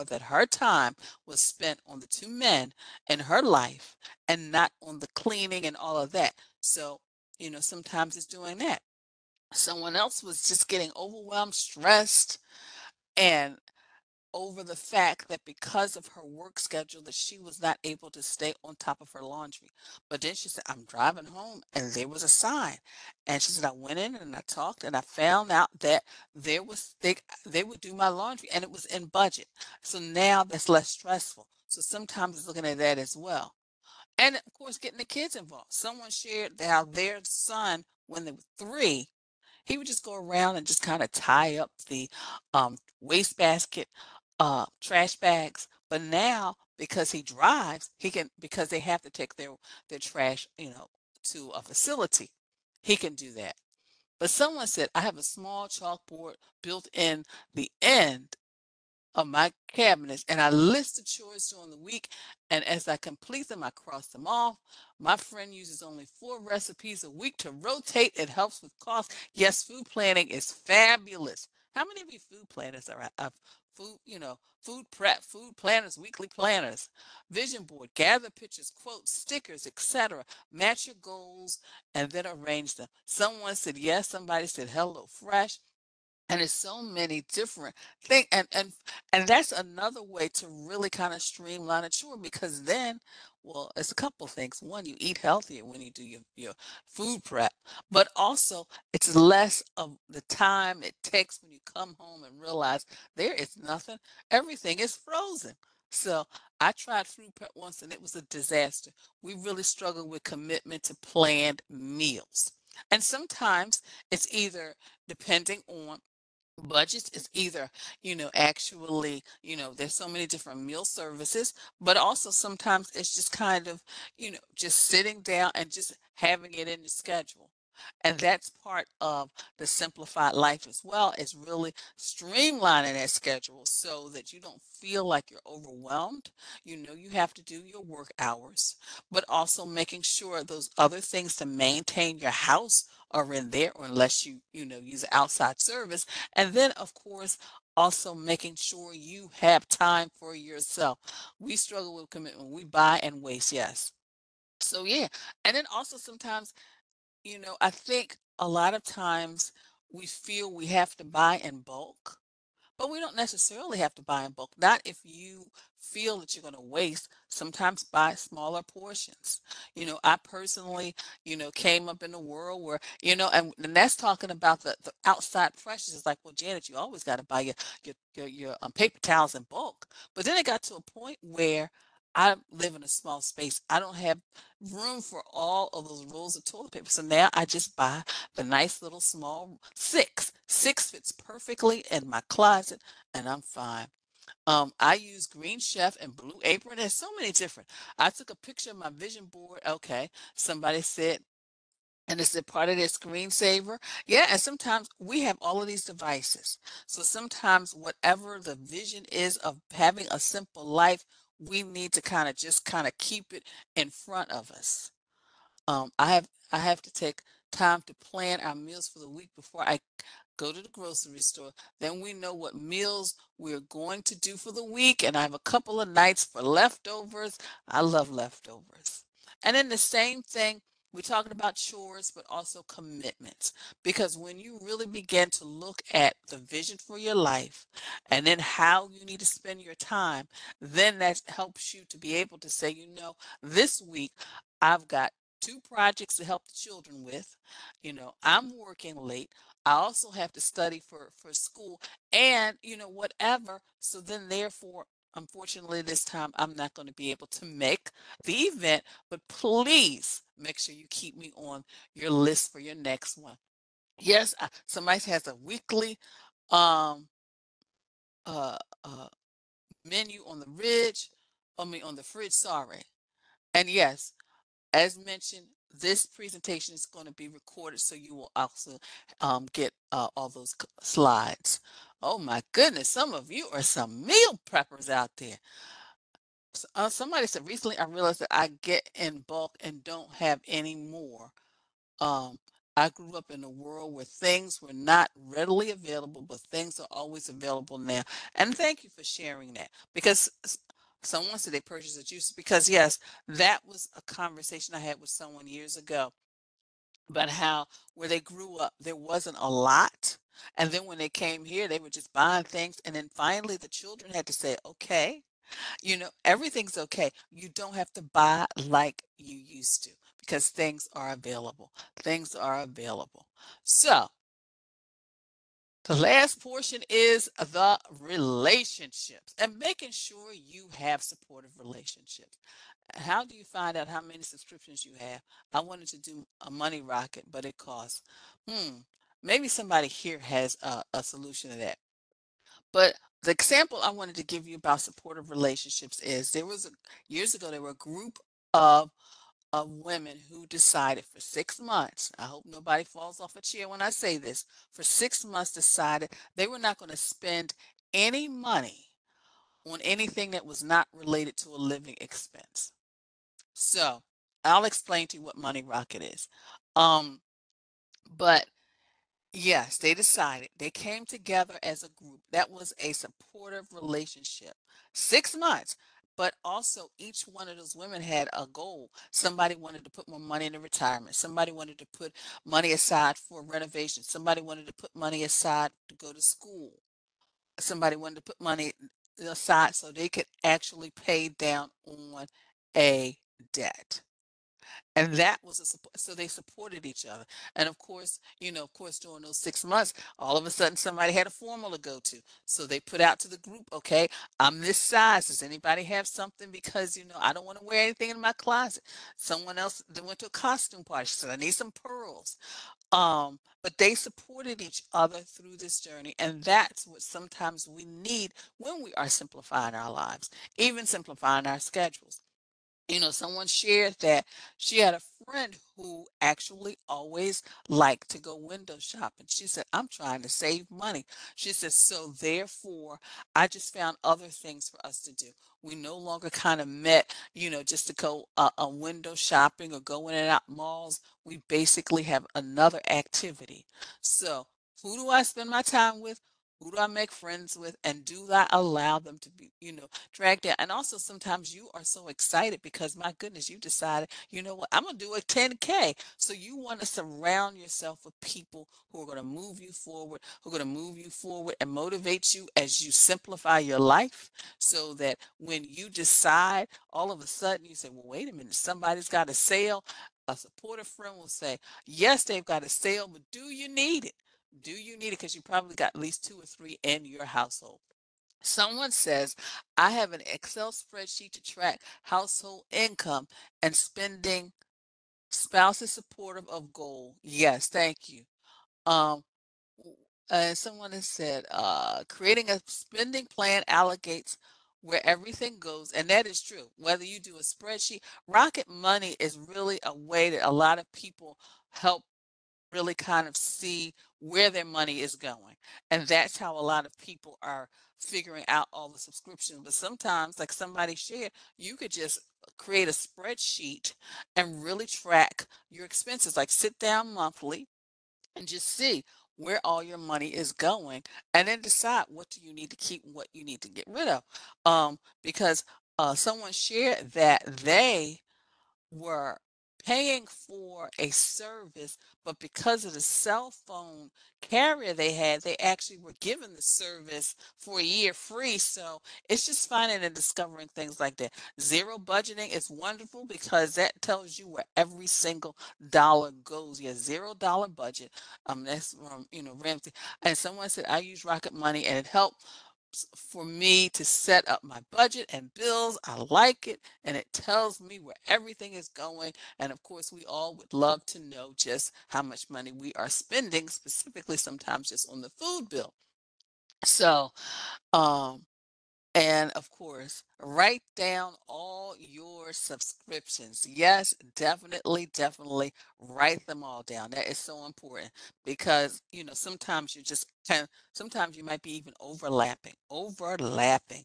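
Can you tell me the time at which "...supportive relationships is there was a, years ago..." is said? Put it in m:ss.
5:44.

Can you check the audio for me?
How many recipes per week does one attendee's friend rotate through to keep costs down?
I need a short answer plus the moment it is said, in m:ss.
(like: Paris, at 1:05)
4, at 1:06.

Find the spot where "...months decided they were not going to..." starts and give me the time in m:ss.
5:55.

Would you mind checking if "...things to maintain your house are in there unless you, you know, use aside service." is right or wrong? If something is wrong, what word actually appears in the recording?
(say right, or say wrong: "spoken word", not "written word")
wrong: "outside", not "aside".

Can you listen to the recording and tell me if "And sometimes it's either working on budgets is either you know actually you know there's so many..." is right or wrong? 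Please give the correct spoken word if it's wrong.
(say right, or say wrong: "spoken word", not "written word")
wrong: "depending", not "working".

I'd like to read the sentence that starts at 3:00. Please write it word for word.
But then it got to a point where I live in a small space.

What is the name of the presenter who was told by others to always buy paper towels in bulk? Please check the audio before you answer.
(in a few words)
Janet.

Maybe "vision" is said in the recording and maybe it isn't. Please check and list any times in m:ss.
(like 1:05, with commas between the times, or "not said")
1:17, 3:18, 3:28, 3:56.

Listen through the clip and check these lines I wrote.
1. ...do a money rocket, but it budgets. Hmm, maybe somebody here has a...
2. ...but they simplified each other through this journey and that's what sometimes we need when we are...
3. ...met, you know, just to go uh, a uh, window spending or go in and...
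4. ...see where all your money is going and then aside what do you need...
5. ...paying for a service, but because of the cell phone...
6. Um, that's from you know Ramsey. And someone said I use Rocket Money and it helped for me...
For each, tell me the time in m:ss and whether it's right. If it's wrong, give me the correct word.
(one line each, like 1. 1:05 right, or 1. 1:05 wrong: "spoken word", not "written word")
1. 5:35 wrong: "costs", not "budgets"
2. 6:53 wrong: "supported", not "simplified"
3. 7:16 wrong: "shopping", not "spending"
4. 8:38 wrong: "decide", not "aside"
5. 8:49 right
6. 9:08 right.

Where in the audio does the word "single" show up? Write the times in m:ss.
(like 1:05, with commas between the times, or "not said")
9:05.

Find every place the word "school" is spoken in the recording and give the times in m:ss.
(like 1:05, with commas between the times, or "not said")
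4:11, 6:26.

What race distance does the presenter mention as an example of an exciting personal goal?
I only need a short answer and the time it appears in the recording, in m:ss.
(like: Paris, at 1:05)
10K, at 7:35.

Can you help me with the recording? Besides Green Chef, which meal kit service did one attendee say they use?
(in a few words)
Blue Apron.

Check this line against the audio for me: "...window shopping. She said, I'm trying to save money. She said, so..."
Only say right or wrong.
right.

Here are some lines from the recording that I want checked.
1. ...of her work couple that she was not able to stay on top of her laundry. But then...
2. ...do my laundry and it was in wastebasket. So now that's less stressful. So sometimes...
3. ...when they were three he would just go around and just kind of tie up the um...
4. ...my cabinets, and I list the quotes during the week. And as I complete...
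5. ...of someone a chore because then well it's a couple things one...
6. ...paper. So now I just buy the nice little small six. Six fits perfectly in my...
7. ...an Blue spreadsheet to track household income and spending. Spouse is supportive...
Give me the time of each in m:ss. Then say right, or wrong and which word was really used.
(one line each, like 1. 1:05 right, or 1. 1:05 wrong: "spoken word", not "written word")
1. 0:15 wrong: "schedule", not "couple"
2. 0:27 wrong: "budget", not "wastebasket"
3. 0:38 right
4. 0:59 wrong: "chores", not "quotes"
5. 1:31 wrong: "streamline", not "someone"
6. 3:06 right
7. 8:00 wrong: "Excel", not "Blue".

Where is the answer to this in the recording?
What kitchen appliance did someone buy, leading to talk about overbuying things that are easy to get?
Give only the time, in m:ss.
5:02.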